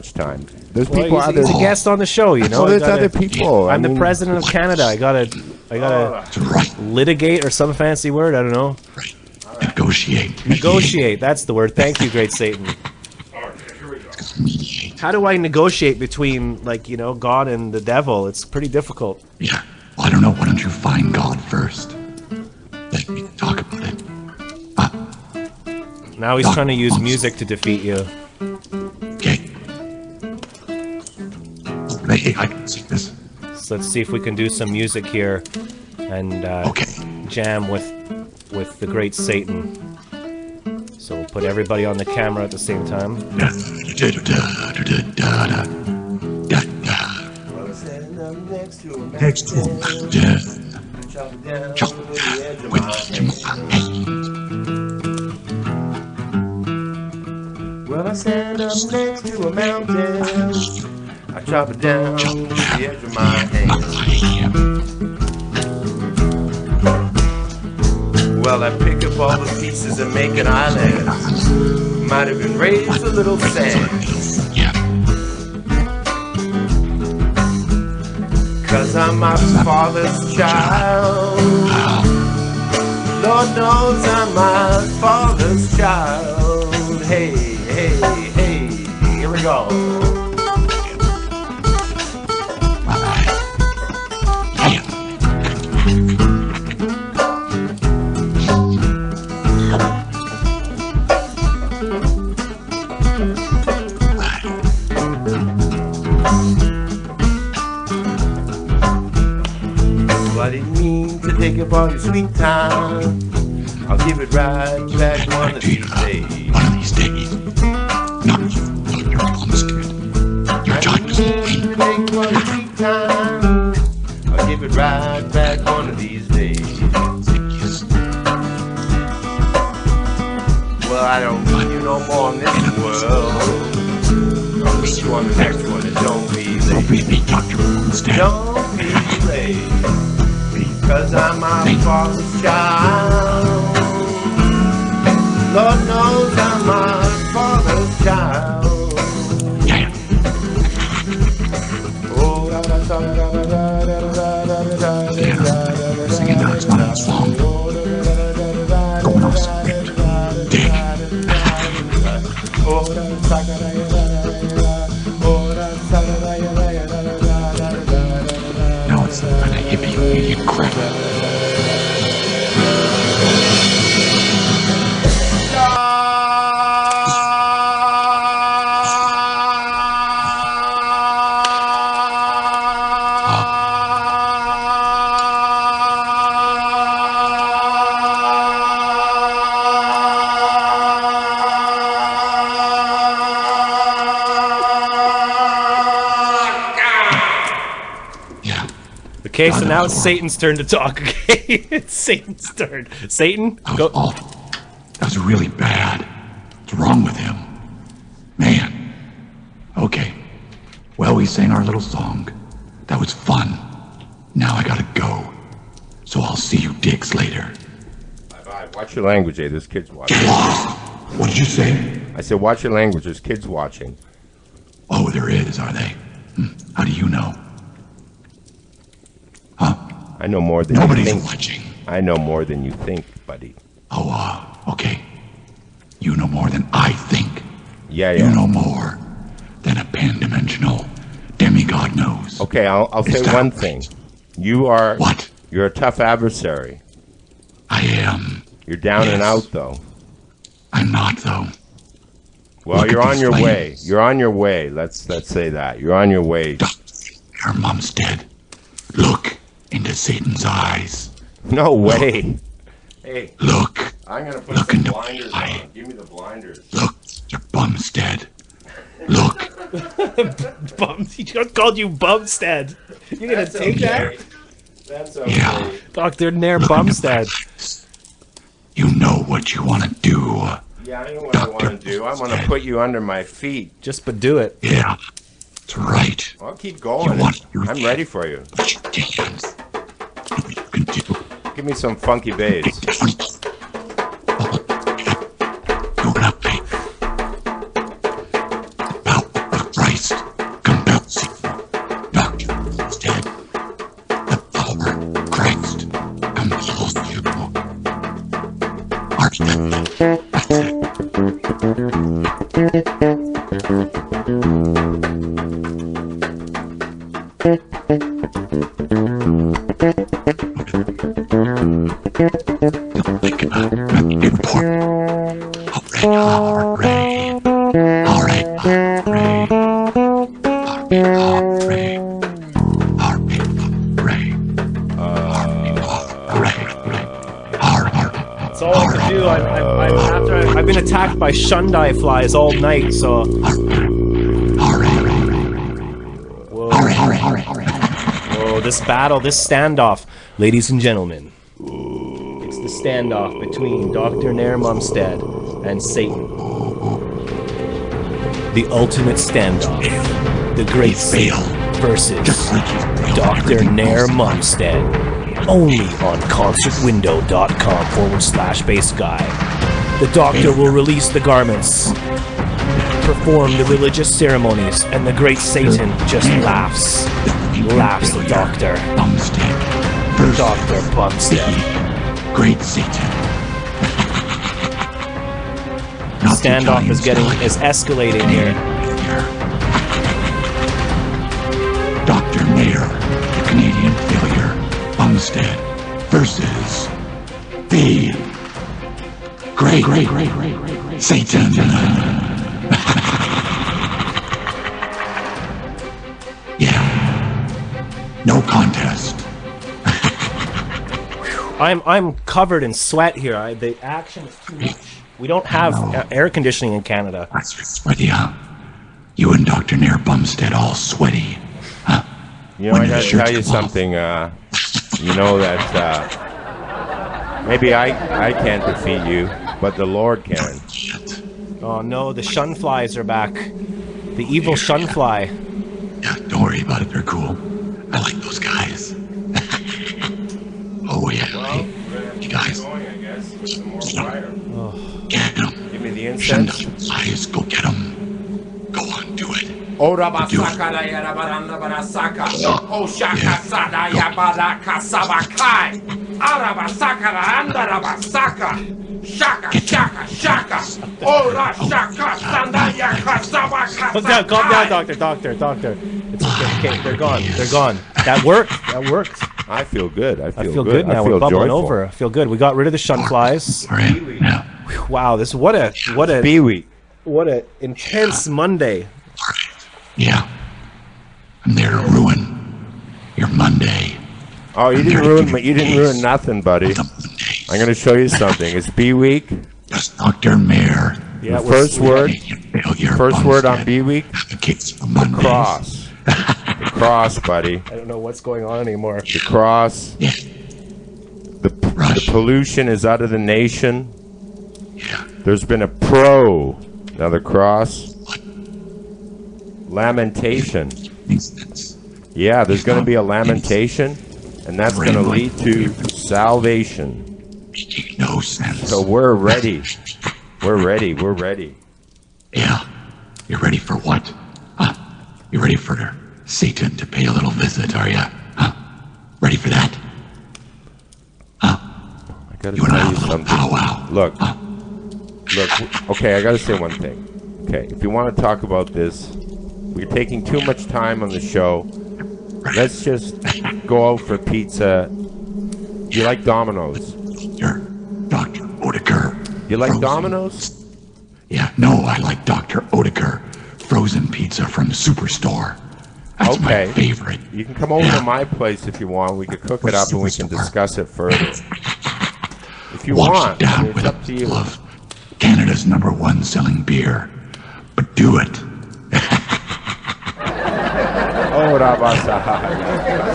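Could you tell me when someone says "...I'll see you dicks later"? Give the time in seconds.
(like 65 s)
216 s.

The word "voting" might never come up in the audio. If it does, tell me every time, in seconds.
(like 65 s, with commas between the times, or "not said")
not said.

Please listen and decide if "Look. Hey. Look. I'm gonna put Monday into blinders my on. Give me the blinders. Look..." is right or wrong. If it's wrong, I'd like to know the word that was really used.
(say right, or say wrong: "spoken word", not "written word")
wrong: "Look", not "Monday".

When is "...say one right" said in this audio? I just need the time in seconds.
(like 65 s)
243 s.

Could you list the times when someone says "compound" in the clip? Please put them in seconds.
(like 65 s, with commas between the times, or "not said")
not said.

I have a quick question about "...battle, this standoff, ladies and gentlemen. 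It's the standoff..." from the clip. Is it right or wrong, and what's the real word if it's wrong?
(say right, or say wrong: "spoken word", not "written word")
right.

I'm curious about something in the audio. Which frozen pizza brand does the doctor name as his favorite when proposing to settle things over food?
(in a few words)
Dr. Oetker.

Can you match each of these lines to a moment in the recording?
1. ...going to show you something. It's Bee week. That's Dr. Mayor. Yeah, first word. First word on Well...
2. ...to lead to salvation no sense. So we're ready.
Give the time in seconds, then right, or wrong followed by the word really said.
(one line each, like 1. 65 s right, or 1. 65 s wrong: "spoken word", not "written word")
1. 487 s wrong: "Bee", not "Well"
2. 514 s right.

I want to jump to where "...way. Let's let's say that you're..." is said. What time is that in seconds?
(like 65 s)
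254 s.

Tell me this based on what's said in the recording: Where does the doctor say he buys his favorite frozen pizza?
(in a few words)
the superstore.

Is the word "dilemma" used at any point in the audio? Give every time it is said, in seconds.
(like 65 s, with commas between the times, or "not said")
not said.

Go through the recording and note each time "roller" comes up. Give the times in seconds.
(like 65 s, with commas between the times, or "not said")
not said.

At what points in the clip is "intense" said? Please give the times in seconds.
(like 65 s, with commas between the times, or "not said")
477 s.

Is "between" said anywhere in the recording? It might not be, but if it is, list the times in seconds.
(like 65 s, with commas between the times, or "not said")
15 s, 353 s.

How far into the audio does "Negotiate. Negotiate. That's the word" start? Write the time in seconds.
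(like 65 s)
9 s.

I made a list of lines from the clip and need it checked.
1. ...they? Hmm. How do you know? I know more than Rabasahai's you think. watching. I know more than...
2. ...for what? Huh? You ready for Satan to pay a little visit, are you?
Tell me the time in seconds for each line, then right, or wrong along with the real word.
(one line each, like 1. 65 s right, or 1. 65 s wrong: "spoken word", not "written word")
1. 225 s wrong: "Nobody", not "Rabasahai"
2. 523 s right.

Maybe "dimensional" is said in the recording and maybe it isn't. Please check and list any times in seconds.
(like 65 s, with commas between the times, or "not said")
239 s.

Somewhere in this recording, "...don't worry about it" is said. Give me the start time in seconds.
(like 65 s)
436 s.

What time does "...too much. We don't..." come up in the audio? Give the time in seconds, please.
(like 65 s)
414 s.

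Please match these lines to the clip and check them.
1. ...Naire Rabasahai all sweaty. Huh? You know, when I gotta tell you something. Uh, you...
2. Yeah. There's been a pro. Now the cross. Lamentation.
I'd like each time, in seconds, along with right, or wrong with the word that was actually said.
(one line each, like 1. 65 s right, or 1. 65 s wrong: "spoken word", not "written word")
1. 419 s wrong: "Bumstead", not "Rabasahai"
2. 504 s right.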